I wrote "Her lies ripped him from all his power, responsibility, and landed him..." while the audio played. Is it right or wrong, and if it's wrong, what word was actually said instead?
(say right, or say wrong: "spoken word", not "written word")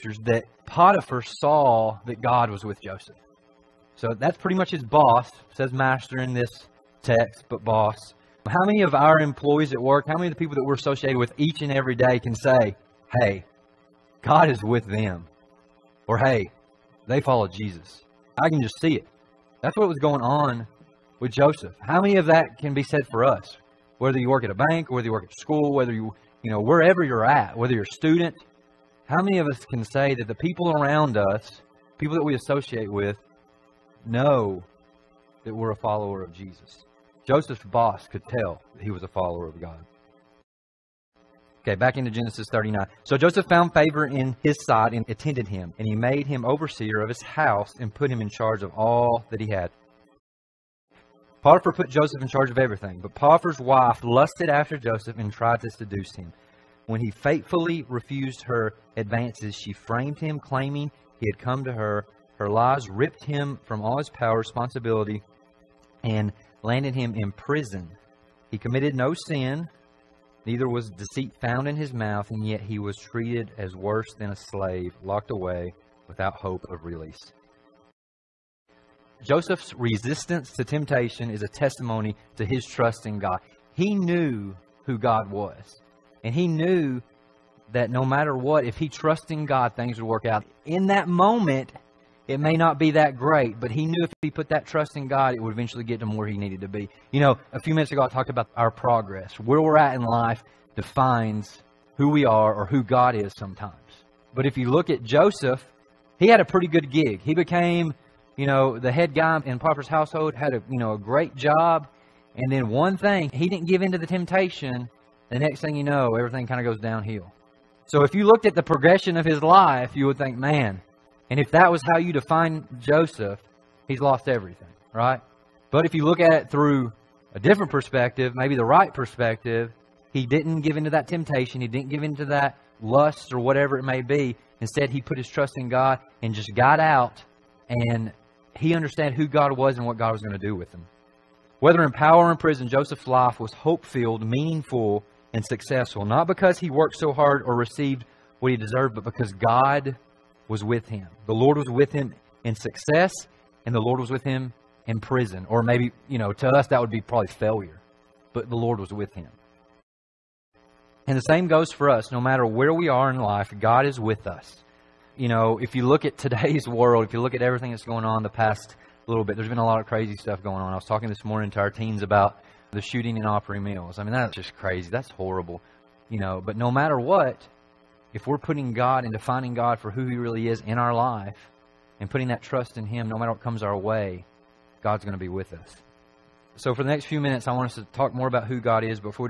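right.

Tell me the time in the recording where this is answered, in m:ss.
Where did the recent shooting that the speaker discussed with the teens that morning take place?
2:53.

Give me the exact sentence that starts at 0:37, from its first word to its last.
Joseph's boss could tell he was a follower of God.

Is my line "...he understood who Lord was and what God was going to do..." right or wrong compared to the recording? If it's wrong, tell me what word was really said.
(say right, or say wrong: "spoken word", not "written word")
wrong: "God", not "Lord".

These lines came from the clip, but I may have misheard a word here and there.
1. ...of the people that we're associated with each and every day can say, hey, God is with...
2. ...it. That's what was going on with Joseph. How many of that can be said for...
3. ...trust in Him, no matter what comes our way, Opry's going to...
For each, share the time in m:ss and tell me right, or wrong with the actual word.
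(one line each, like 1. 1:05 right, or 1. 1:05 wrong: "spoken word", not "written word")
1. 0:10 right
2. 0:18 right
3. 3:02 wrong: "God", not "Opry".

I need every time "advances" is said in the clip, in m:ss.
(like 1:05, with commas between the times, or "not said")
0:58.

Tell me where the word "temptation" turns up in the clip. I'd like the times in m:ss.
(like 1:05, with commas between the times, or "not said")
1:20, 1:54, 2:11.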